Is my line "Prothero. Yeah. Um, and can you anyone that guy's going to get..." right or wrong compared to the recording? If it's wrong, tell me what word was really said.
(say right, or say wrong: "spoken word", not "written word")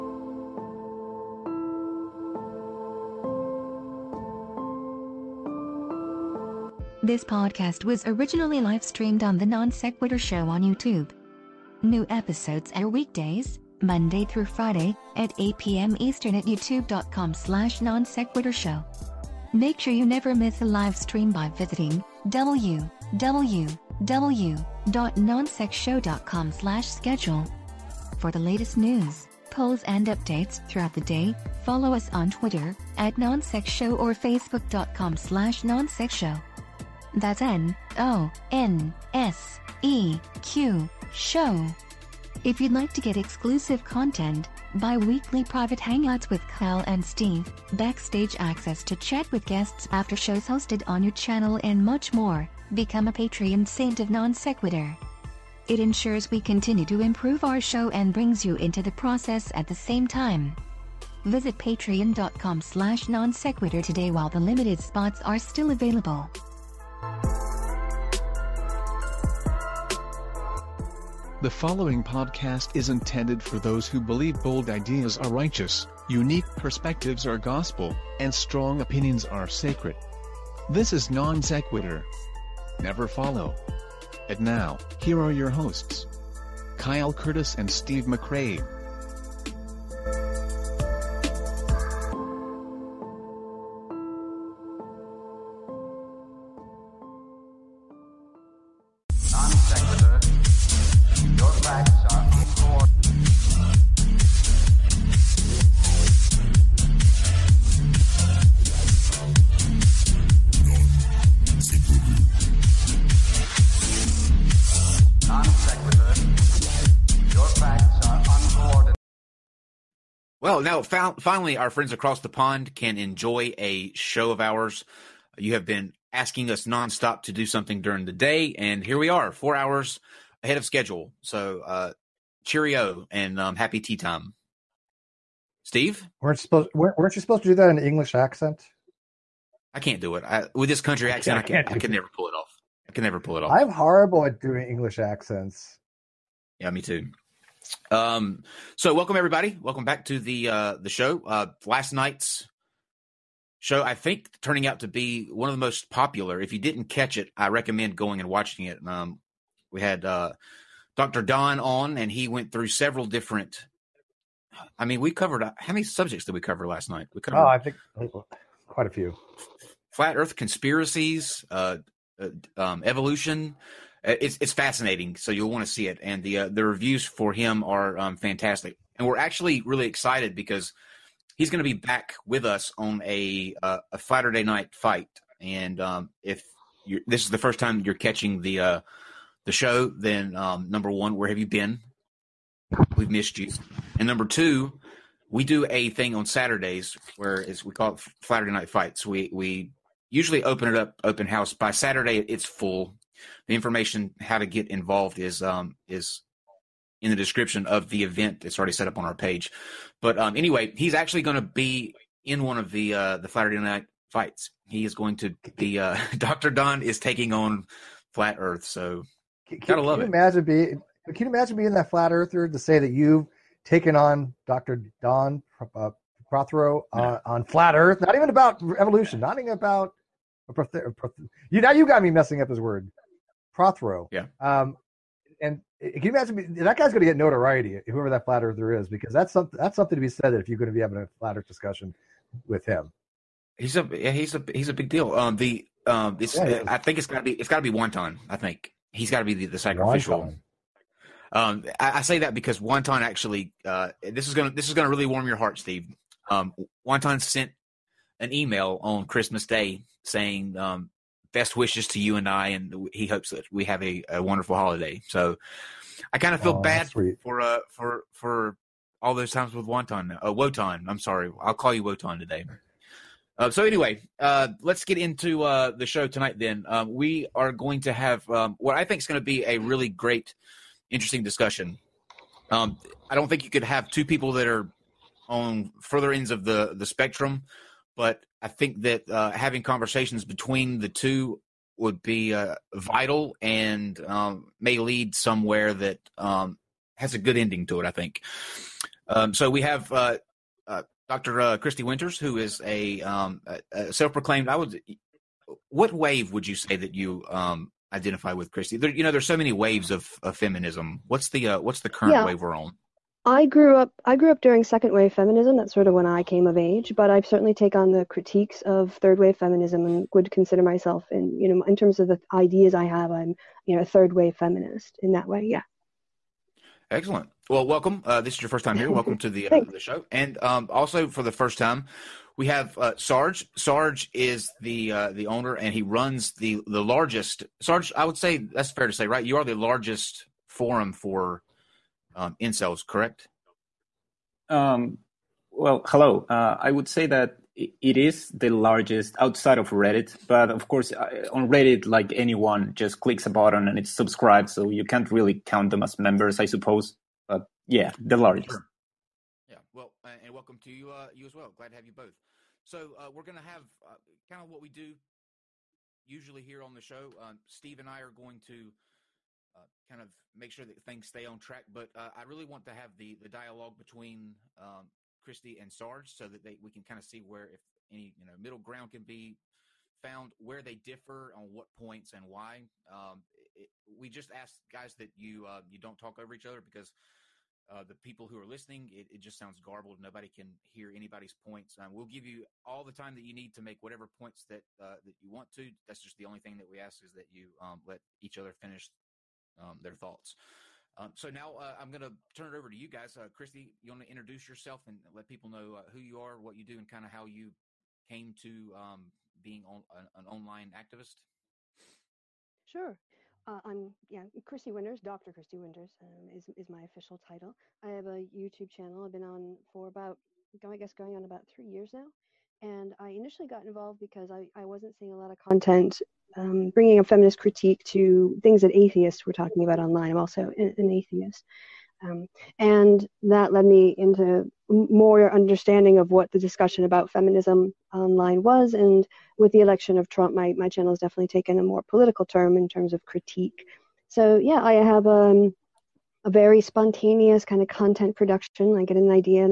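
wrong: "imagine", not "anyone".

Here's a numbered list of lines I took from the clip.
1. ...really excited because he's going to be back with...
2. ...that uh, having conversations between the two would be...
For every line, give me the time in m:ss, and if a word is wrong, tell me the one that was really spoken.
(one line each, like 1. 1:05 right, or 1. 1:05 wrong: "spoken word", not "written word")
1. 2:59 right
2. 4:48 right.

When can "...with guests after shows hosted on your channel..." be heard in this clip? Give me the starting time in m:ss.
0:49.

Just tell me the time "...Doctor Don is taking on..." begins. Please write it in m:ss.
3:36.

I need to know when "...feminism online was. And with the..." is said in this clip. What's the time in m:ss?
7:17.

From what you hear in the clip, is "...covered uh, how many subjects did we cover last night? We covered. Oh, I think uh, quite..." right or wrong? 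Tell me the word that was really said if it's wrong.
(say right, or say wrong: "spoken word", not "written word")
right.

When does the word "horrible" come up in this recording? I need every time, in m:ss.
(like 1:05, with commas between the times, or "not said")
2:23.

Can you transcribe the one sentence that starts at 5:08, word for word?
There, you know, there's so many waves of, of feminism.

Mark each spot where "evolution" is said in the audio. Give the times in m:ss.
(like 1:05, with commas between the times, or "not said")
2:52, 3:48.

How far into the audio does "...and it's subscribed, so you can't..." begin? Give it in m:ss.
5:53.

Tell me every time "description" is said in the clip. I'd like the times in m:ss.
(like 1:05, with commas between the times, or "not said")
3:27.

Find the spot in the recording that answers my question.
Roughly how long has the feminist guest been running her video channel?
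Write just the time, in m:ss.
7:01.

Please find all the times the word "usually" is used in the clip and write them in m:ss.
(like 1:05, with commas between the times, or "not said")
3:20, 6:06.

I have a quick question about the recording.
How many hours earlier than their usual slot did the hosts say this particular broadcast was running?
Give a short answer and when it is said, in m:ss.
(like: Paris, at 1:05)
4, at 2:09.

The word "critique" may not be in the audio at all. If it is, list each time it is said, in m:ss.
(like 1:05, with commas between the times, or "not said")
5:18, 7:07, 7:23.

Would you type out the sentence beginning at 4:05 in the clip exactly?
Um, the um, it's yeah, uh, I think it's got to be it's got to be Wonton.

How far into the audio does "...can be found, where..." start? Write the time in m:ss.
6:18.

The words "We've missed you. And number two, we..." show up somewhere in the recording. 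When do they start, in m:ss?
3:12.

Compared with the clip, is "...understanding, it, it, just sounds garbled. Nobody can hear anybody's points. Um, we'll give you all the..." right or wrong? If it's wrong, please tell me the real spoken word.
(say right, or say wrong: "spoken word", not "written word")
wrong: "listening", not "understanding".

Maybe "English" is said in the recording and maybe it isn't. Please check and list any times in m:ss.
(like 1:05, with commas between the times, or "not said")
2:17, 2:24.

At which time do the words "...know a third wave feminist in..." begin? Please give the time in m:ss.
5:23.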